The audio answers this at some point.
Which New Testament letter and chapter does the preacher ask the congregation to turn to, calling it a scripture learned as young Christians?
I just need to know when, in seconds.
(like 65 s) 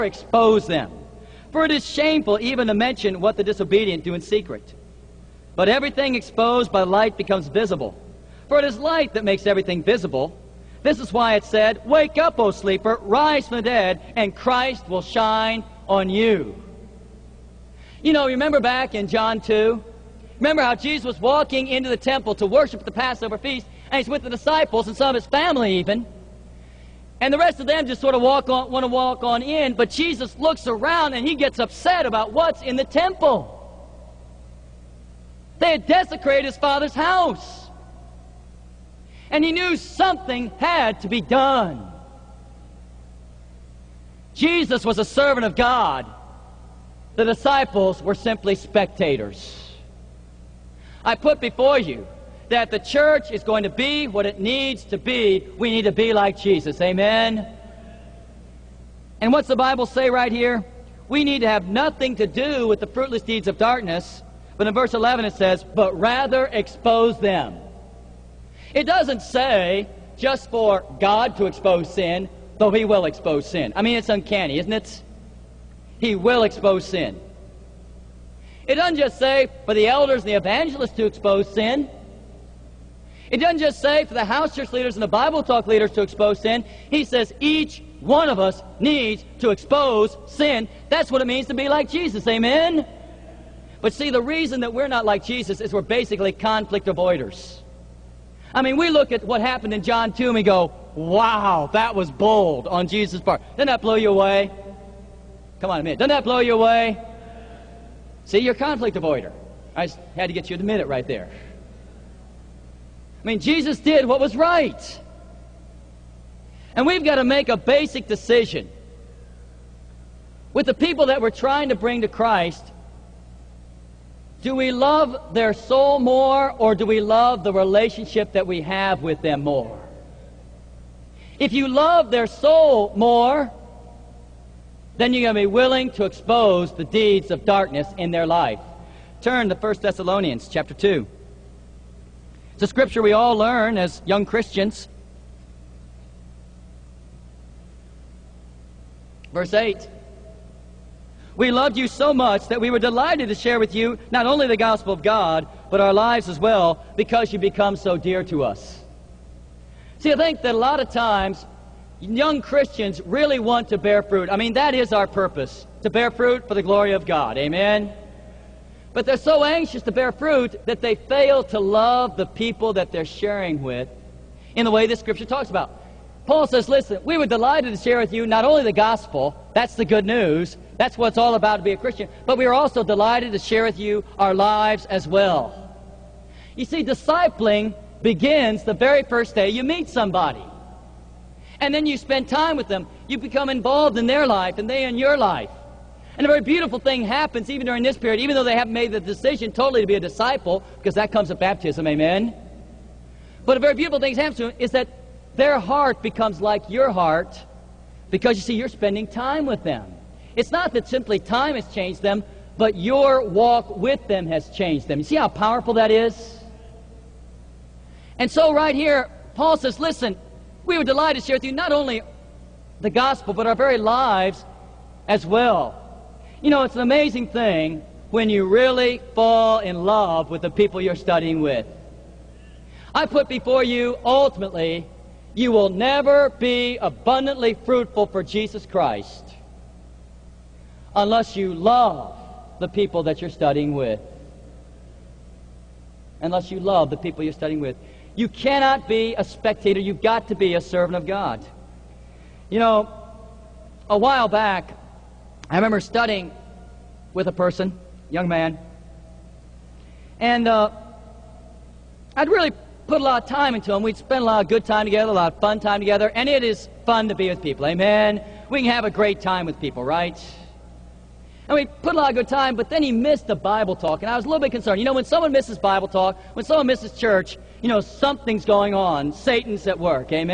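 139 s.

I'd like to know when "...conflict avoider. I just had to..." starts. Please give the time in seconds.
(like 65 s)
108 s.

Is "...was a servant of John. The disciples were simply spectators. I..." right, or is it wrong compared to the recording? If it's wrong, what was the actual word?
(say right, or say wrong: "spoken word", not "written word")
wrong: "God", not "John".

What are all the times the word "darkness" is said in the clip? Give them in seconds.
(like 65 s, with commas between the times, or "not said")
63 s, 137 s.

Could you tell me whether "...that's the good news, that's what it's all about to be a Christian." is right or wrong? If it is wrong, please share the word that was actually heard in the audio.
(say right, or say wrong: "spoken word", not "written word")
right.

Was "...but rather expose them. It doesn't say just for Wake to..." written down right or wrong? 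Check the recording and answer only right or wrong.
wrong.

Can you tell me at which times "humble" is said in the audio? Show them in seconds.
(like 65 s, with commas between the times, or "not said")
not said.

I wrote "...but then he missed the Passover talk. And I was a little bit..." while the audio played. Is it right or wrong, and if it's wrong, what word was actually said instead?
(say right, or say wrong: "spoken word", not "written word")
wrong: "Bible", not "Passover".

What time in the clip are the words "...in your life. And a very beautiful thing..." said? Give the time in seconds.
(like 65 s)
194 s.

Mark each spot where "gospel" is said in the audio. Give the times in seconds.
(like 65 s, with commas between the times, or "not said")
154 s, 178 s, 222 s.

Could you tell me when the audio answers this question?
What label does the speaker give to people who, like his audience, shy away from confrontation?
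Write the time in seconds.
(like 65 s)
96 s.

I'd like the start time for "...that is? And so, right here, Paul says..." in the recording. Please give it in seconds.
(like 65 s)
215 s.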